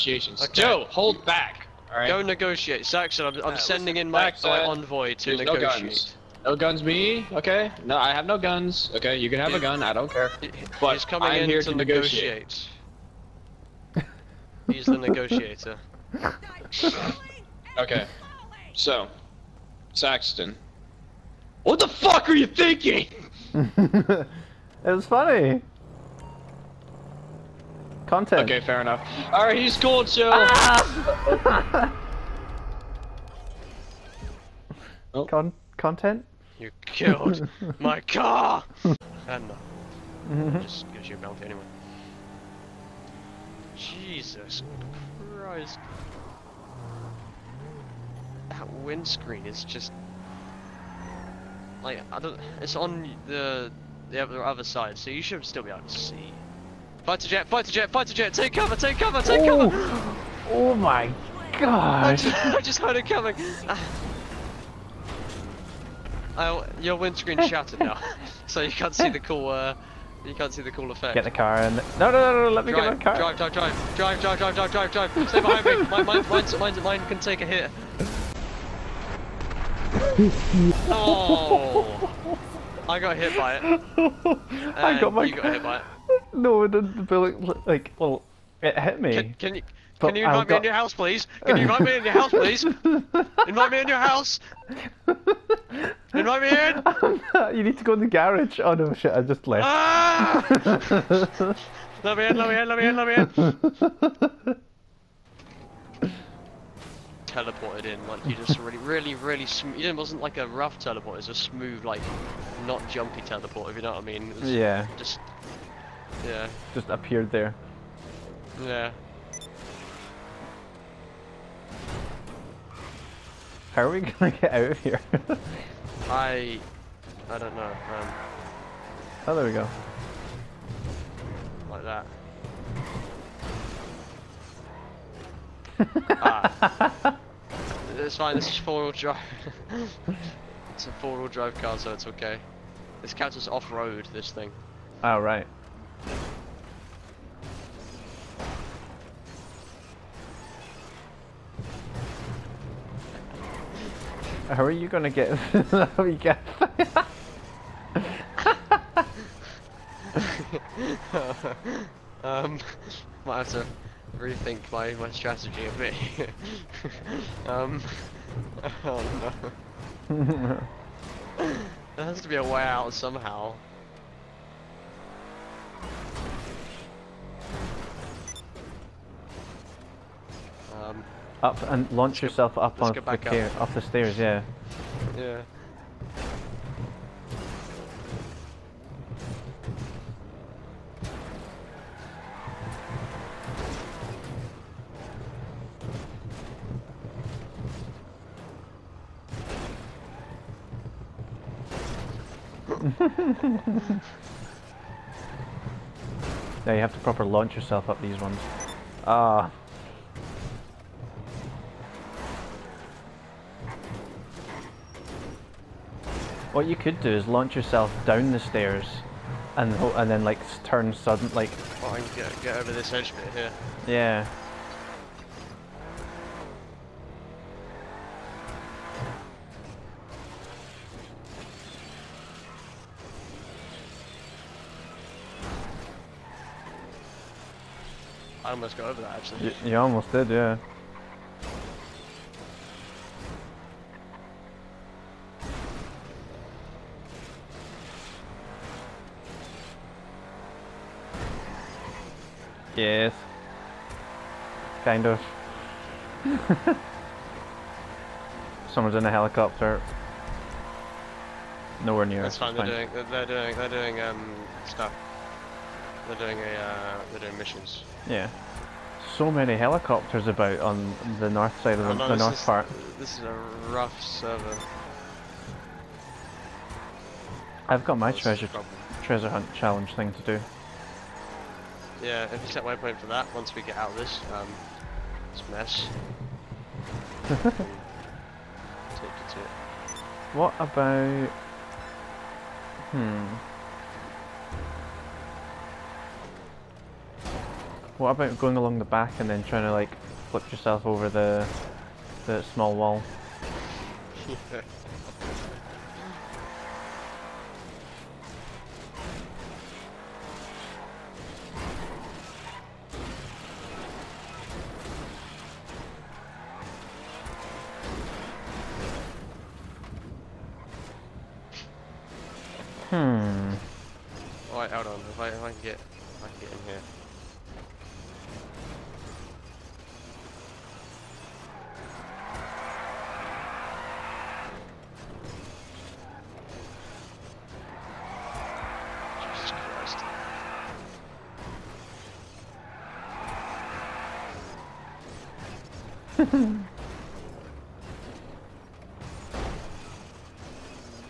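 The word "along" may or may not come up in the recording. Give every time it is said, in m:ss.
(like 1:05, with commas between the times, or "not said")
4:58.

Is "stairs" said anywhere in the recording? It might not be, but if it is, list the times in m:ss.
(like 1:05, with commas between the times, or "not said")
3:03, 3:38.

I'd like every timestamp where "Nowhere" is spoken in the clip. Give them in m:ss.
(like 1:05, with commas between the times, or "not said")
4:21.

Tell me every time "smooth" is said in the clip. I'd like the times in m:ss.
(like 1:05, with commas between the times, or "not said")
1:51.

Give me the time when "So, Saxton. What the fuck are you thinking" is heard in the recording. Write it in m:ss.
0:18.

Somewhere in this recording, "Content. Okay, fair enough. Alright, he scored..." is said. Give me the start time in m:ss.
0:28.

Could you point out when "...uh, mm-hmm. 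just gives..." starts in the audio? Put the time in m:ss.
0:39.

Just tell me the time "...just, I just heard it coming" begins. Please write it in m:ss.
1:02.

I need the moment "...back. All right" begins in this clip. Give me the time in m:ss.
0:01.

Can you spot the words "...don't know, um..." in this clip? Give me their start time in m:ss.
2:07.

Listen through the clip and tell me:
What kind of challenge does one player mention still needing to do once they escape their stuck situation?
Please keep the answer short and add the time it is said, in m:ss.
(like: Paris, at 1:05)
Treasure hunt, at 4:39.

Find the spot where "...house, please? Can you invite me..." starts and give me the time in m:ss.
1:30.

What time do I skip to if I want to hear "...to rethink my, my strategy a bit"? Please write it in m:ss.
2:43.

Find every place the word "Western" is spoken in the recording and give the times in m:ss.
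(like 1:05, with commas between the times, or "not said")
not said.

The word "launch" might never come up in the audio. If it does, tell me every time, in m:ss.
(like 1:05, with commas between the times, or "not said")
3:01, 3:27, 3:37.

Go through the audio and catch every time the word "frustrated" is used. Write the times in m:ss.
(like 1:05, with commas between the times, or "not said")
not said.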